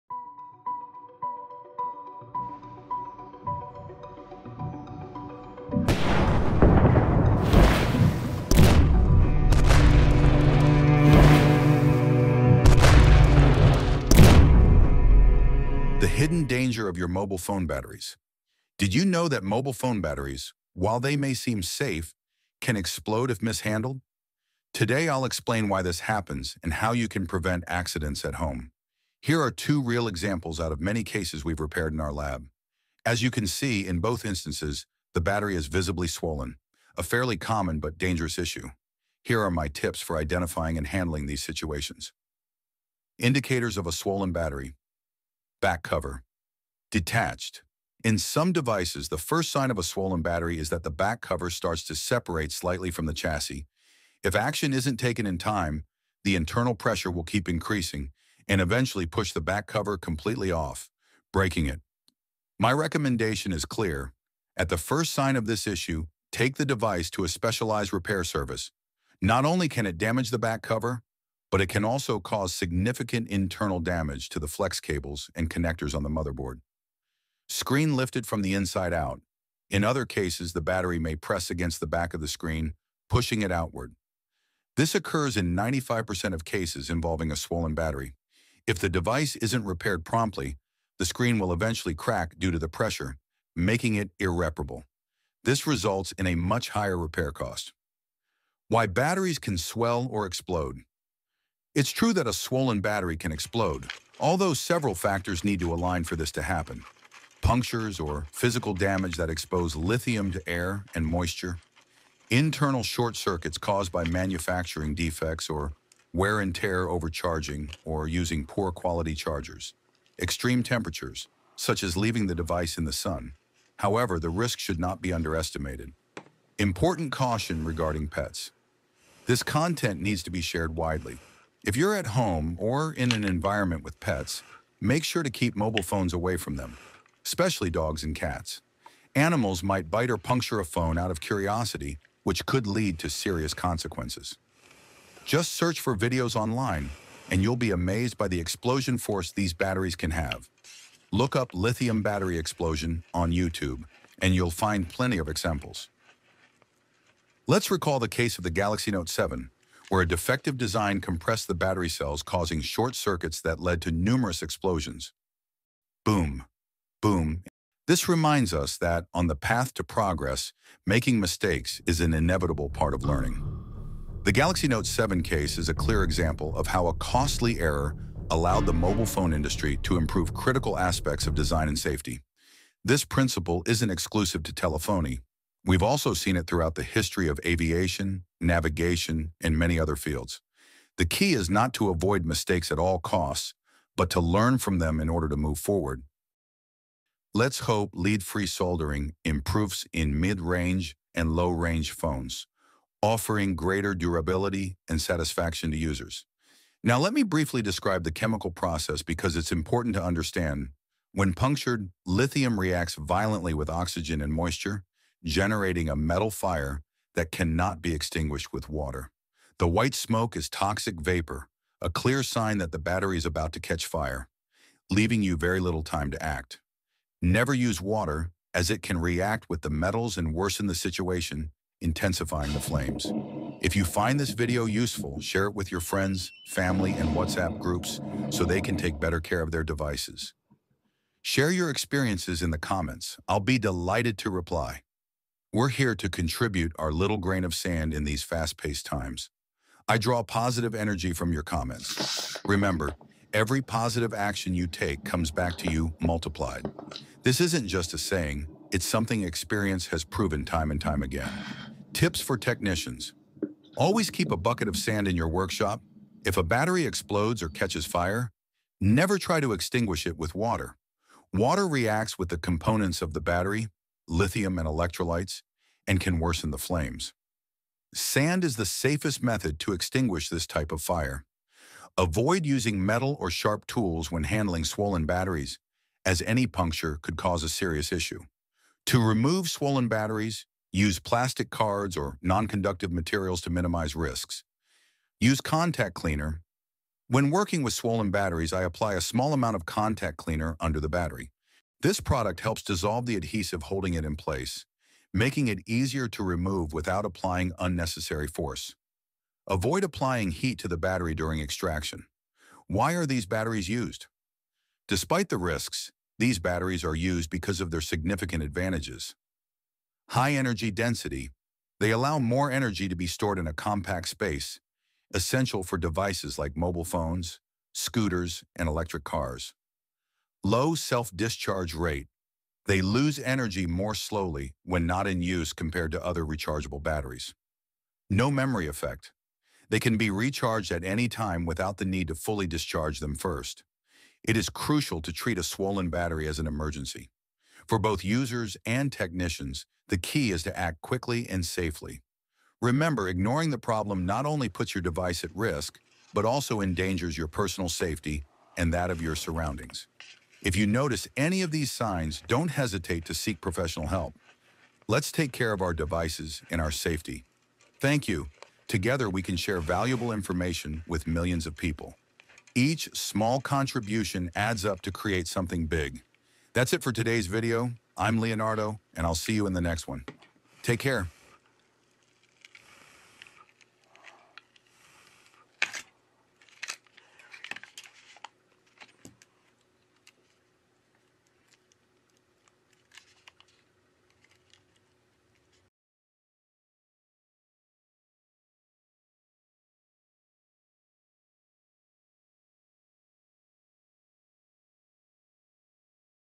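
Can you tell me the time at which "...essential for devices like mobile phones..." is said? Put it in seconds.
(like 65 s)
325 s.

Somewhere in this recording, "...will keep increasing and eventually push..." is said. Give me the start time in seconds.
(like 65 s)
57 s.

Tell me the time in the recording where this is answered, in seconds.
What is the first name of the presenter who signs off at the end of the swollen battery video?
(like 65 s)
378 s.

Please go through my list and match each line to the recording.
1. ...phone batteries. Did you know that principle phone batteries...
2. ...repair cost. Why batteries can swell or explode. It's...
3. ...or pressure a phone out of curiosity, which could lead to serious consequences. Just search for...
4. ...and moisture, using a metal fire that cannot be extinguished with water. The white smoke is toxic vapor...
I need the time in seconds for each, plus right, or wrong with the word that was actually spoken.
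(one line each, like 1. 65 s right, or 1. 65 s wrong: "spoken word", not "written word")
1. 17 s wrong: "mobile", not "principle"
2. 96 s right
3. 140 s wrong: "puncture", not "pressure"
4. 214 s wrong: "generating", not "using".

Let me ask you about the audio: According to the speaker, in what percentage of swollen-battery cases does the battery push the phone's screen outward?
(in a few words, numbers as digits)
95%.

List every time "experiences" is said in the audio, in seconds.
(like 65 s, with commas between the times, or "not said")
241 s, 259 s.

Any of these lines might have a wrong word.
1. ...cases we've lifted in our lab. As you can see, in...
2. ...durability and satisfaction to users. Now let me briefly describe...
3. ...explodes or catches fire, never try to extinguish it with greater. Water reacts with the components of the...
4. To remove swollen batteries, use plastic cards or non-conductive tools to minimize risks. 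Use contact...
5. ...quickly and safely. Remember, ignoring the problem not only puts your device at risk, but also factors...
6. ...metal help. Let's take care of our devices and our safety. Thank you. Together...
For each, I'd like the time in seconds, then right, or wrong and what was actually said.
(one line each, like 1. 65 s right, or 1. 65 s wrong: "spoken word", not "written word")
1. 31 s wrong: "repaired", not "lifted"
2. 203 s right
3. 266 s wrong: "water", not "greater"
4. 288 s wrong: "materials", not "tools"
5. 350 s wrong: "endangers", not "factors"
6. 363 s wrong: "professional", not "metal".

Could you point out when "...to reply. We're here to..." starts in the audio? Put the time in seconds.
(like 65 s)
244 s.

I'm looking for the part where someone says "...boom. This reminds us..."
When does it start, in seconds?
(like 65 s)
167 s.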